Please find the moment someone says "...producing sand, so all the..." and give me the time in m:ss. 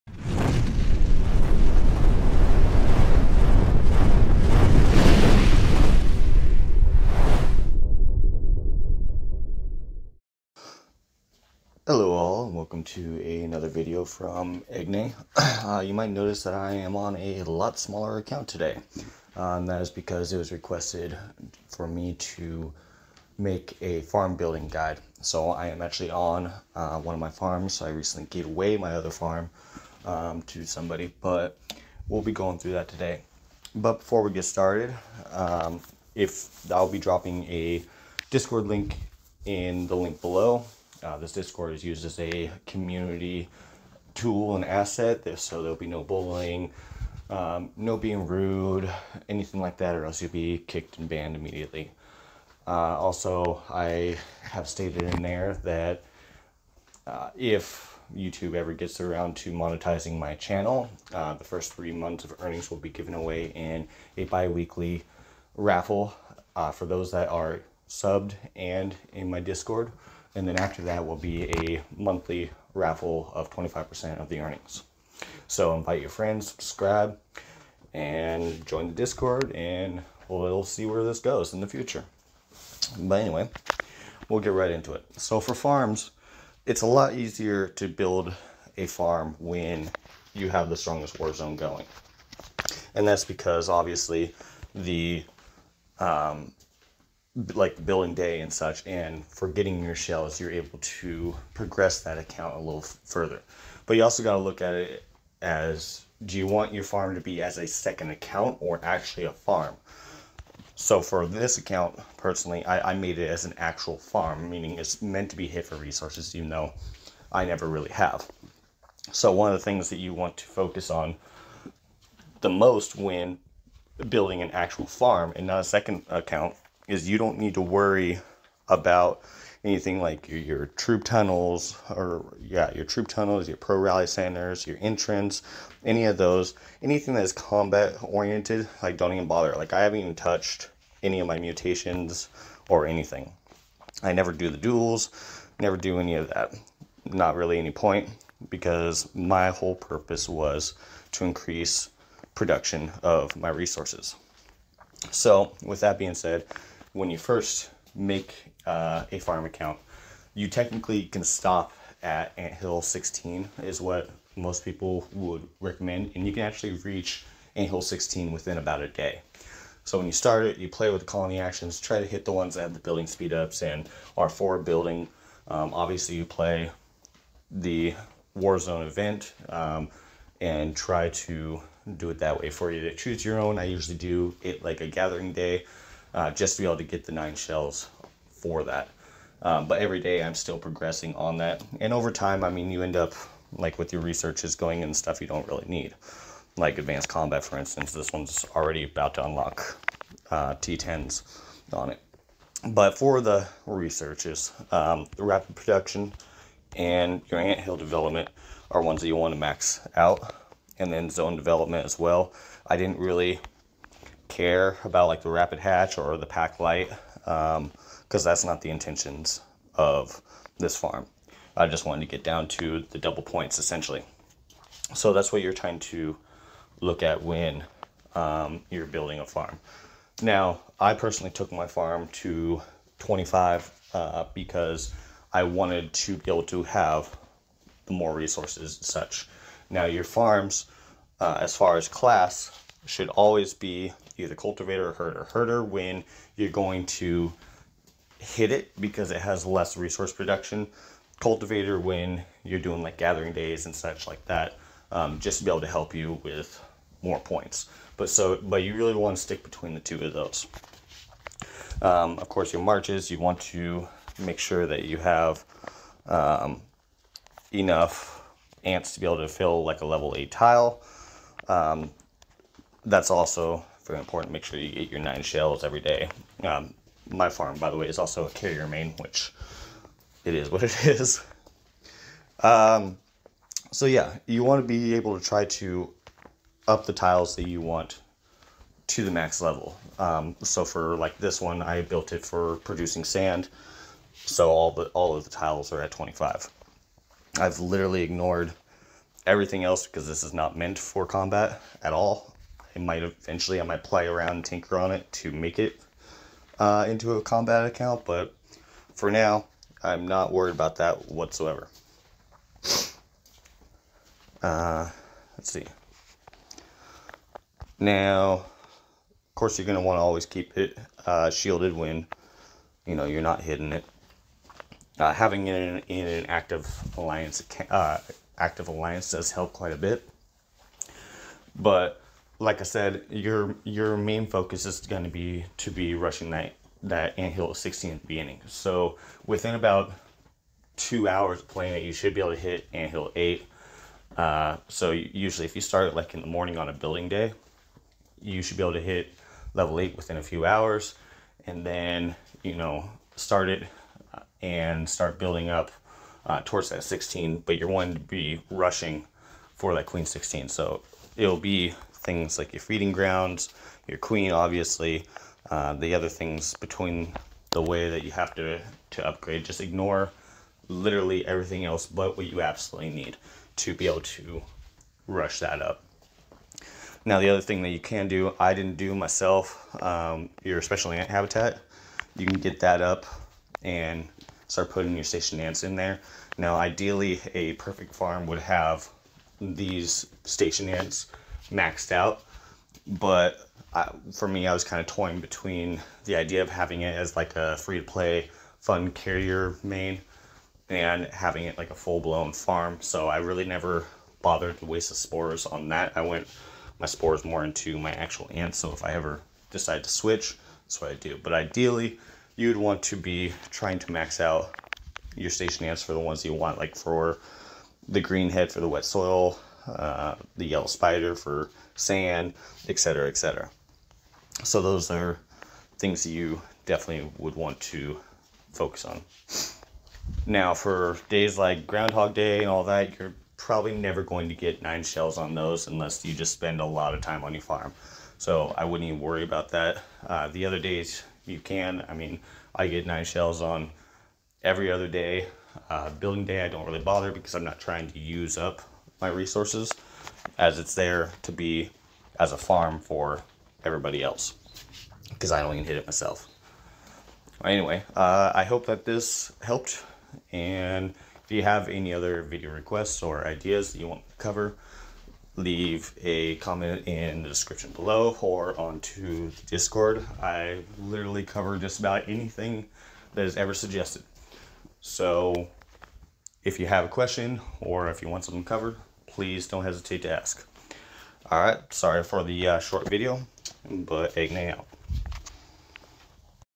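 4:52.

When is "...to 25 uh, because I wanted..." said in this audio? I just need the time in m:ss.
3:52.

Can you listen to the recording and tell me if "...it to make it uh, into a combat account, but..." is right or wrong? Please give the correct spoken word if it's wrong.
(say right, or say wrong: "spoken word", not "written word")
right.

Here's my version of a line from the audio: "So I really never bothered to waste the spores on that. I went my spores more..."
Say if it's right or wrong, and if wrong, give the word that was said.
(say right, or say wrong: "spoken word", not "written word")
right.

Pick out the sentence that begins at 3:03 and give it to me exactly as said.
I usually do it like a gathering day uh, just to be able to get the nine shells for that.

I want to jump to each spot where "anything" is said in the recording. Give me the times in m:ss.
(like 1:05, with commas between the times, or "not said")
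0:49, 2:09, 2:16, 2:22, 7:52.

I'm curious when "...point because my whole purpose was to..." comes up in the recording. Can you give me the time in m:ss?
2:27.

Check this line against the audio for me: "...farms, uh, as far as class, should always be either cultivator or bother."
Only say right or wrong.
wrong.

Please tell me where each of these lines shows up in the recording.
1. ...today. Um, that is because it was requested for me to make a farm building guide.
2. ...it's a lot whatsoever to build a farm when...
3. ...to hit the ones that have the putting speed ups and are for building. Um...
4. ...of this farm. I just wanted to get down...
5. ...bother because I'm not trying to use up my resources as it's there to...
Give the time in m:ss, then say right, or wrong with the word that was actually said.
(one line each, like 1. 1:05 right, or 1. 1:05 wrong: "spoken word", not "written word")
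1. 0:18 right
2. 1:26 wrong: "easier", not "whatsoever"
3. 2:51 wrong: "building", not "putting"
4. 3:39 right
5. 7:26 right.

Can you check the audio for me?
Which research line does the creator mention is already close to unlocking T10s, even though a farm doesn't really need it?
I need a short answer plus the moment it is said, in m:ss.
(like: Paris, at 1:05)
Advanced combat, at 3:16.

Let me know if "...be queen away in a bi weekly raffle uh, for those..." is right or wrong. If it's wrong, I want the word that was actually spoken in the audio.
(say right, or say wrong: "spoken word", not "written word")
wrong: "given", not "queen".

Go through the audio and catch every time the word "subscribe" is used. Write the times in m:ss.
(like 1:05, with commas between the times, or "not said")
1:16.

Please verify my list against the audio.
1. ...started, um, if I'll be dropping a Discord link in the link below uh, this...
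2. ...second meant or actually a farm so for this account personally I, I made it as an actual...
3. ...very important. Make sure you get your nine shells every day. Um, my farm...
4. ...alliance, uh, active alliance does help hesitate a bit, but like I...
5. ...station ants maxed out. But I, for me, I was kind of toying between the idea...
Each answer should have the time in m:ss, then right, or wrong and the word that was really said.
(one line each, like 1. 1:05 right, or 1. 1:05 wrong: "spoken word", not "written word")
1. 0:34 right
2. 1:47 wrong: "account", not "meant"
3. 4:33 right
4. 5:26 wrong: "quite", not "hesitate"
5. 6:30 right.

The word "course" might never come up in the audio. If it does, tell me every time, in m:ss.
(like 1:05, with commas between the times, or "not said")
4:22, 5:19.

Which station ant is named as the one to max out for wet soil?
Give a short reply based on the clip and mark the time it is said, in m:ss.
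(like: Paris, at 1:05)
Green head, at 6:57.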